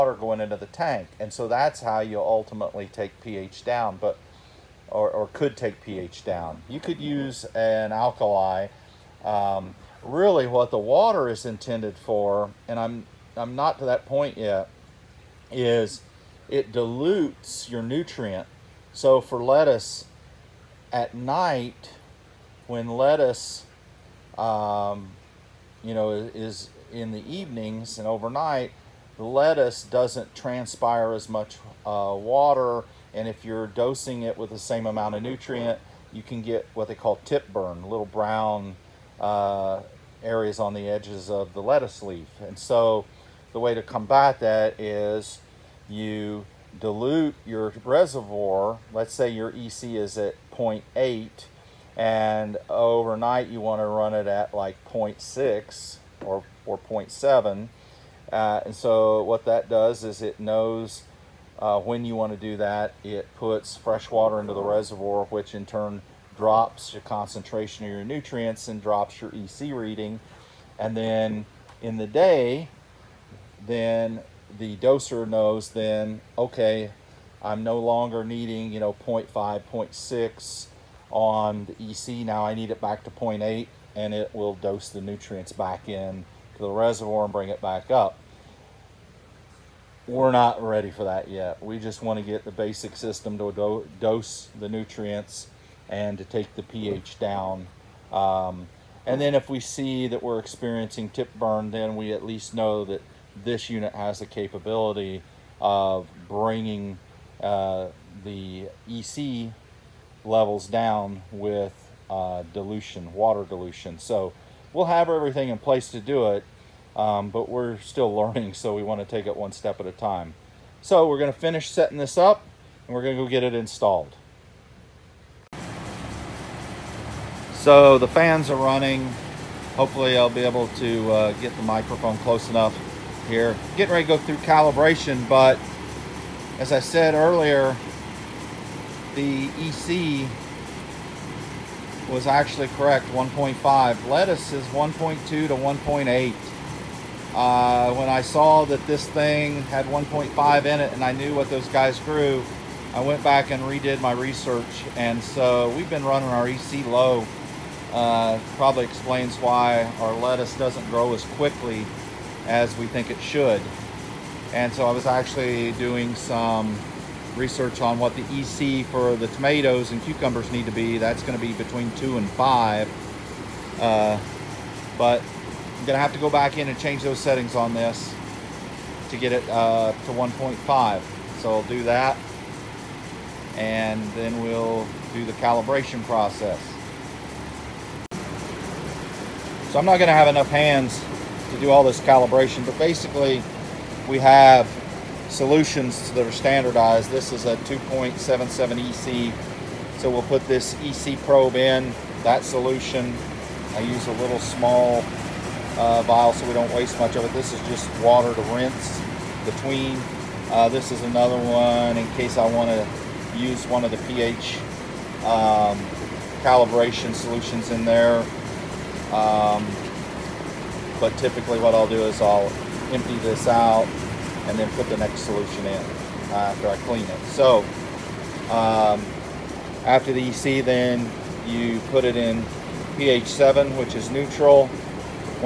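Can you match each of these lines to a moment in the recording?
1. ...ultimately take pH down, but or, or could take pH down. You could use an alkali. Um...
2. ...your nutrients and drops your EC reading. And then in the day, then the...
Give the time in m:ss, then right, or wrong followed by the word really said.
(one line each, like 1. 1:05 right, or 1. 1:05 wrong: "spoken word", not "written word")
1. 0:02 right
2. 1:07 right.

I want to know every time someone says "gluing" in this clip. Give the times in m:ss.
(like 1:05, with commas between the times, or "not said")
not said.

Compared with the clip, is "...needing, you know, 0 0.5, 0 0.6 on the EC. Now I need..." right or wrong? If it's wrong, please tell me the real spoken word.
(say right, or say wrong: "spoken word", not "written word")
right.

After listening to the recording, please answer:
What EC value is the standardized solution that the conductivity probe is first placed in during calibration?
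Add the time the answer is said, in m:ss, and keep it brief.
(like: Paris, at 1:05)
2.77, at 3:17.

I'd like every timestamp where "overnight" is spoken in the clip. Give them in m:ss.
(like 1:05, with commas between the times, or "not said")
0:28, 0:52.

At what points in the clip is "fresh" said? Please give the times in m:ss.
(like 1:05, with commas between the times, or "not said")
1:03.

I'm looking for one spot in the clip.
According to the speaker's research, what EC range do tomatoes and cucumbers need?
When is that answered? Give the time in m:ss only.
2:51.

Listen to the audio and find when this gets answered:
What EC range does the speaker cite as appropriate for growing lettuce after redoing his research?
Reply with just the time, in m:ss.
2:24.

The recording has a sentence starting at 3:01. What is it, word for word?
So I'll do that and then we'll do the calibration process.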